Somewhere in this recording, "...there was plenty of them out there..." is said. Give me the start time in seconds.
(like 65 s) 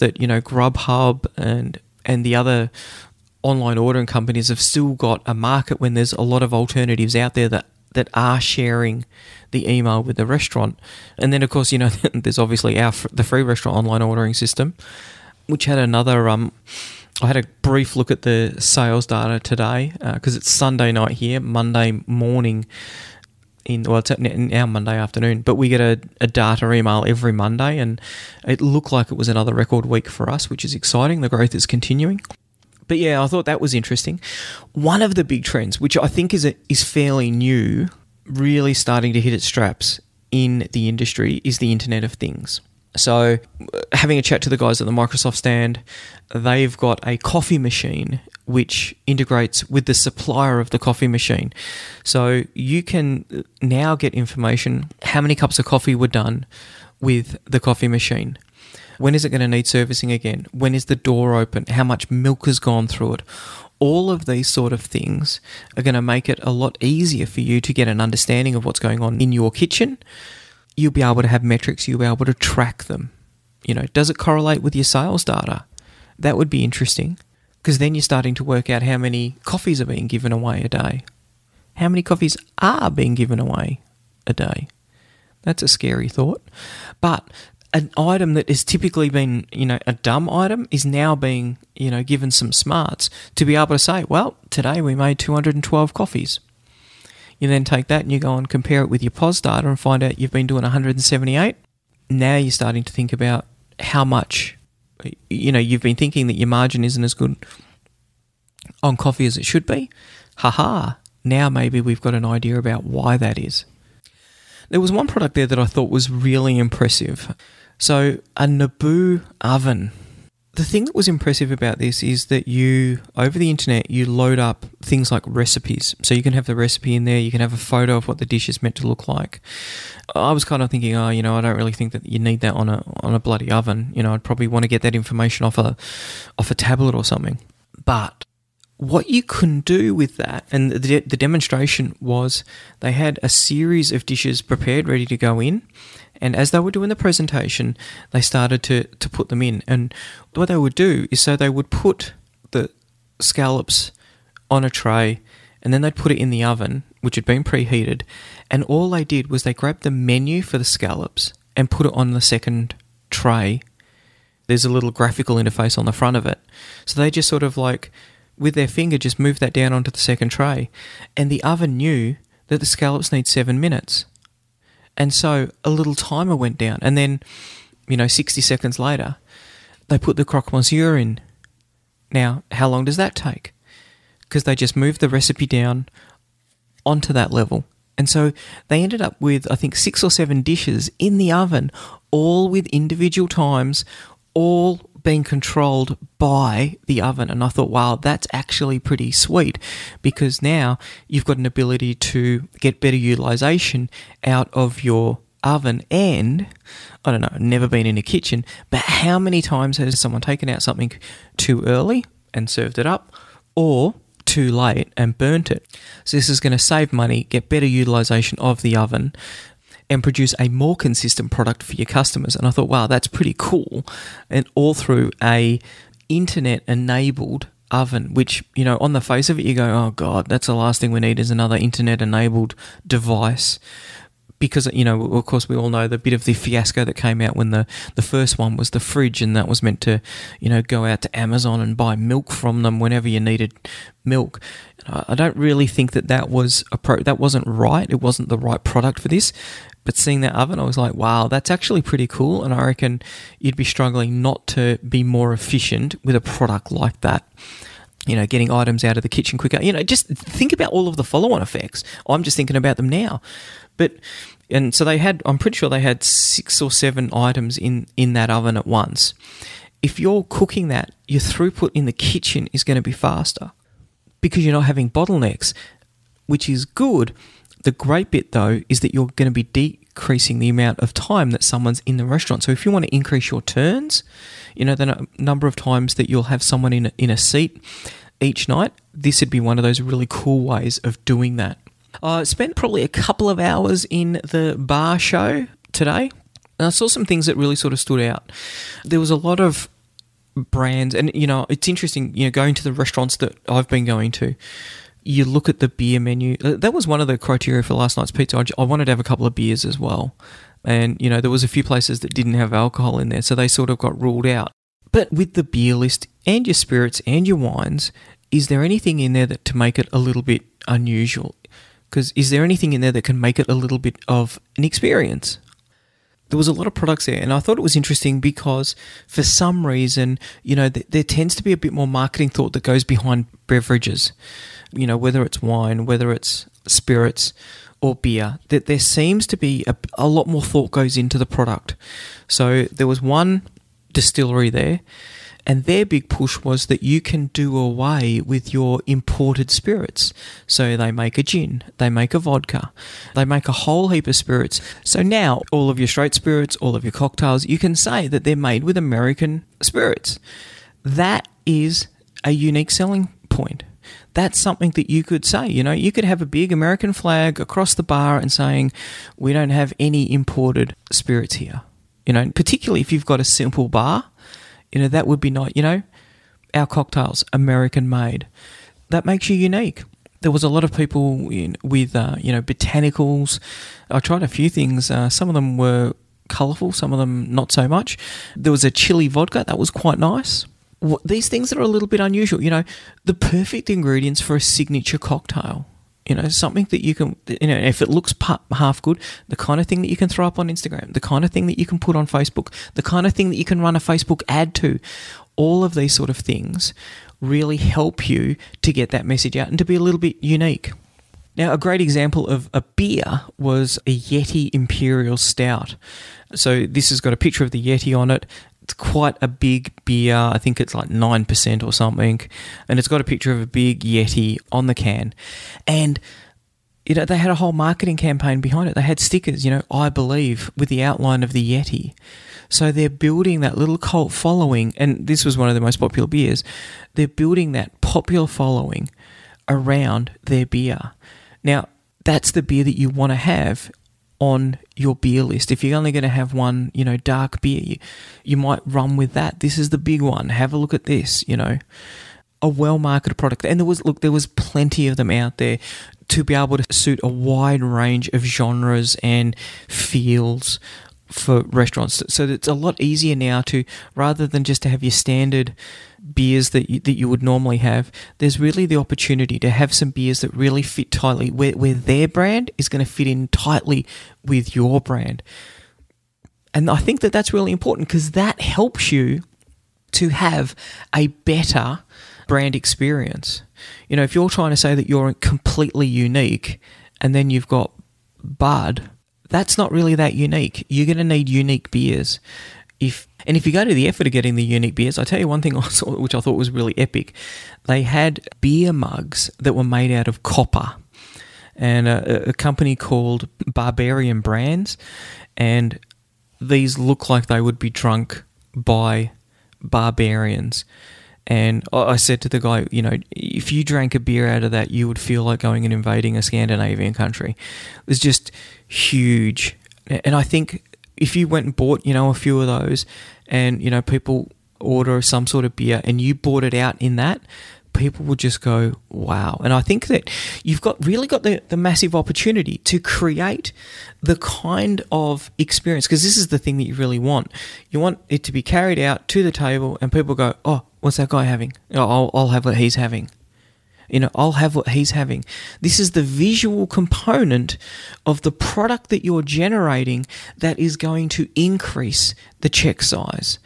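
454 s.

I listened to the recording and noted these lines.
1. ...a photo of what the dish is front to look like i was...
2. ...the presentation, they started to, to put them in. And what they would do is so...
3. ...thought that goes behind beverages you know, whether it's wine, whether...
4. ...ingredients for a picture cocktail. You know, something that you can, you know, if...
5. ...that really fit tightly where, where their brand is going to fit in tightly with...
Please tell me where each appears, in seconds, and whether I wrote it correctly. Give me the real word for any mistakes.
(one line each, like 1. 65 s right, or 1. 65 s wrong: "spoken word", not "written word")
1. 127 s wrong: "meant", not "front"
2. 146 s right
3. 332 s right
4. 393 s wrong: "signature", not "picture"
5. 470 s right.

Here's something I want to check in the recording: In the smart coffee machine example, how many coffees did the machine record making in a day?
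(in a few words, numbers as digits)
212.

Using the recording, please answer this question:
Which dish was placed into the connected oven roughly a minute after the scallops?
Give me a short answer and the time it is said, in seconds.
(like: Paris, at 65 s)
croque monsieur, at 180 s.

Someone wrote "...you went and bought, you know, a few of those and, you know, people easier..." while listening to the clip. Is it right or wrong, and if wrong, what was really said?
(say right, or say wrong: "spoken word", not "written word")
wrong: "order", not "easier".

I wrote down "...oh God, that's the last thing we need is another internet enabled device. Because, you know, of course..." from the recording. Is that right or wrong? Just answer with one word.
right.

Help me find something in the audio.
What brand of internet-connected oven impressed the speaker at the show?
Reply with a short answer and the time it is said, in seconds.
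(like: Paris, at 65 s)
Naboo, at 118 s.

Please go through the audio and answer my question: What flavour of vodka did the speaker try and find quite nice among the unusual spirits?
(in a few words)
chili.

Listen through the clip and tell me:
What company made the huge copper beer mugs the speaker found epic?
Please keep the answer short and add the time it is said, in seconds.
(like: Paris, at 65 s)
Barbarian Brands, at 503 s.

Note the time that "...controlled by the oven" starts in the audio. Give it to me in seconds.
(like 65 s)
195 s.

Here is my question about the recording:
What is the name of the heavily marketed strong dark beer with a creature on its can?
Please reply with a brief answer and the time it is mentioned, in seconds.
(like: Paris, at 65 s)
Yeti Imperial Stout, at 413 s.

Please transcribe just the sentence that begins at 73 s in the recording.
You know, does it correlate with your sales data?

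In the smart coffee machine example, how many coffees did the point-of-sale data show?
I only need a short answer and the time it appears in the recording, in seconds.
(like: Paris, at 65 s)
178, at 100 s.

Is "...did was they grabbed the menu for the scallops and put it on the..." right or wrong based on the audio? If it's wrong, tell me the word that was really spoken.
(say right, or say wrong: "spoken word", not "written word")
right.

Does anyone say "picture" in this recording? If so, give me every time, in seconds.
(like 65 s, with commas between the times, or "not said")
417 s, 423 s.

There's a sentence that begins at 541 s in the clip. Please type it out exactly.
Oh, I'll, I'll have what he's having.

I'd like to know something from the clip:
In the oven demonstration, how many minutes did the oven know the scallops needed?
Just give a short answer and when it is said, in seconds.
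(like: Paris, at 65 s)
7 minutes, at 173 s.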